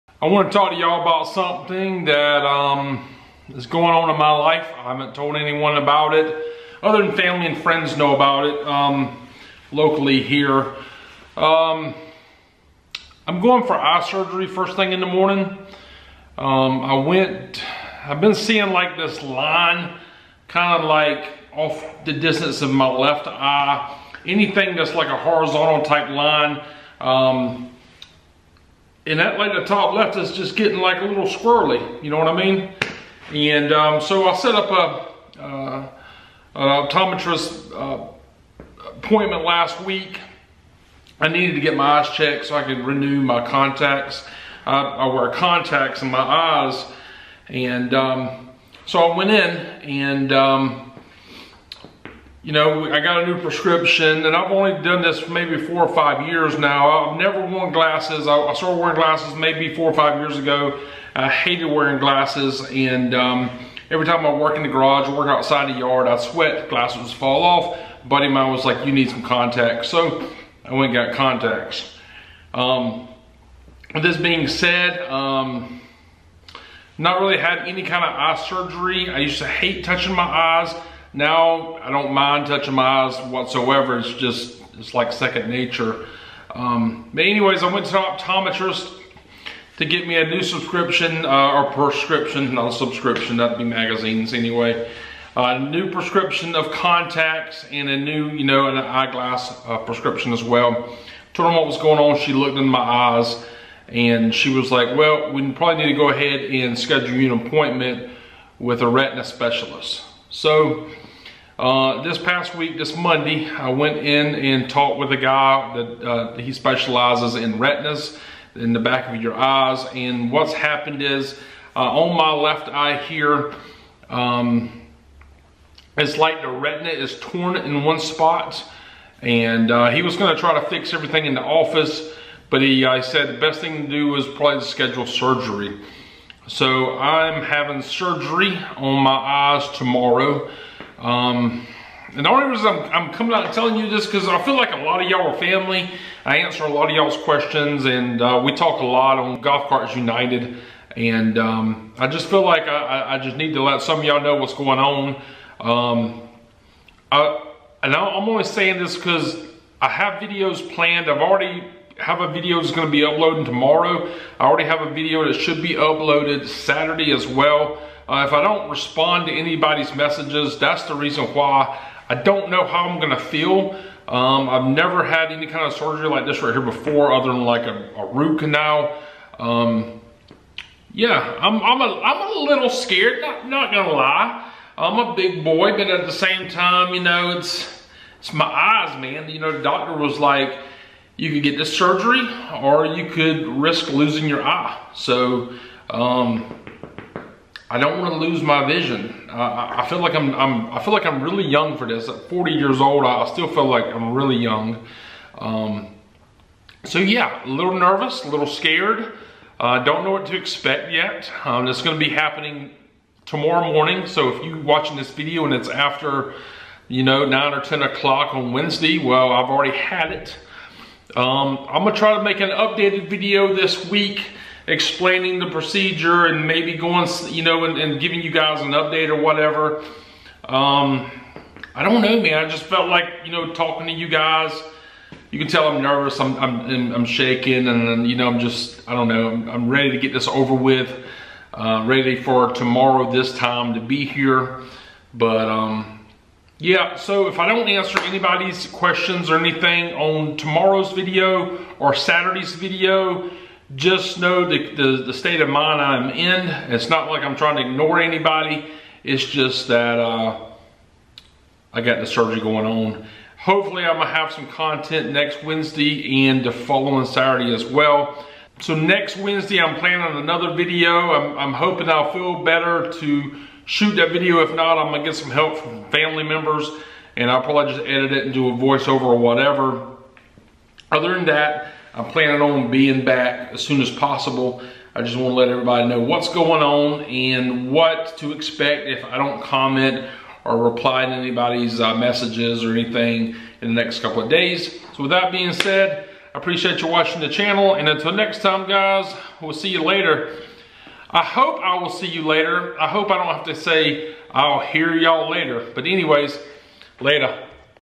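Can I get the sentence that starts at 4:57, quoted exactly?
And until next time, guys, we'll see you later.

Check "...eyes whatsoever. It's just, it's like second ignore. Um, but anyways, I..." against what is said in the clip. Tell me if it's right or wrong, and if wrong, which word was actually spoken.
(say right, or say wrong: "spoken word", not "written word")
wrong: "nature", not "ignore".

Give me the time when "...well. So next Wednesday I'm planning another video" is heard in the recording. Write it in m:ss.
4:27.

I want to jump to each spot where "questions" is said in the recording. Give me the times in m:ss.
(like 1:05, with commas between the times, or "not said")
2:27, 4:08.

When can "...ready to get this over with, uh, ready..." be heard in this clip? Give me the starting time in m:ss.
3:59.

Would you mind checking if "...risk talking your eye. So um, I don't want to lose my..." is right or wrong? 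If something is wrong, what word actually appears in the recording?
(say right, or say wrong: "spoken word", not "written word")
wrong: "losing", not "talking".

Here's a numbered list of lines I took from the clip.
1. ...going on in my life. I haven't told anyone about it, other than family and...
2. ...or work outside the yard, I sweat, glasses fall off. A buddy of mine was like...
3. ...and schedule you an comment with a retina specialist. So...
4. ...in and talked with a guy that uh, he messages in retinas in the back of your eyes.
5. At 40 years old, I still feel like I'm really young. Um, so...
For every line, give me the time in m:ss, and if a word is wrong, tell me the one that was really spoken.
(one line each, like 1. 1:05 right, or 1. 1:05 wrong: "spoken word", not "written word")
1. 0:03 right
2. 1:05 right
3. 1:46 wrong: "appointment", not "comment"
4. 1:53 wrong: "specializes", not "messages"
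5. 3:22 right.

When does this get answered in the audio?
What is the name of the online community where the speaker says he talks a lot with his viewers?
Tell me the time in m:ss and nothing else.
2:29.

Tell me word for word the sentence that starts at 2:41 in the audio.
I've already have a video that's going to be uploading tomorrow.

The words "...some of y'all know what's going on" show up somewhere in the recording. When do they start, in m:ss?
2:33.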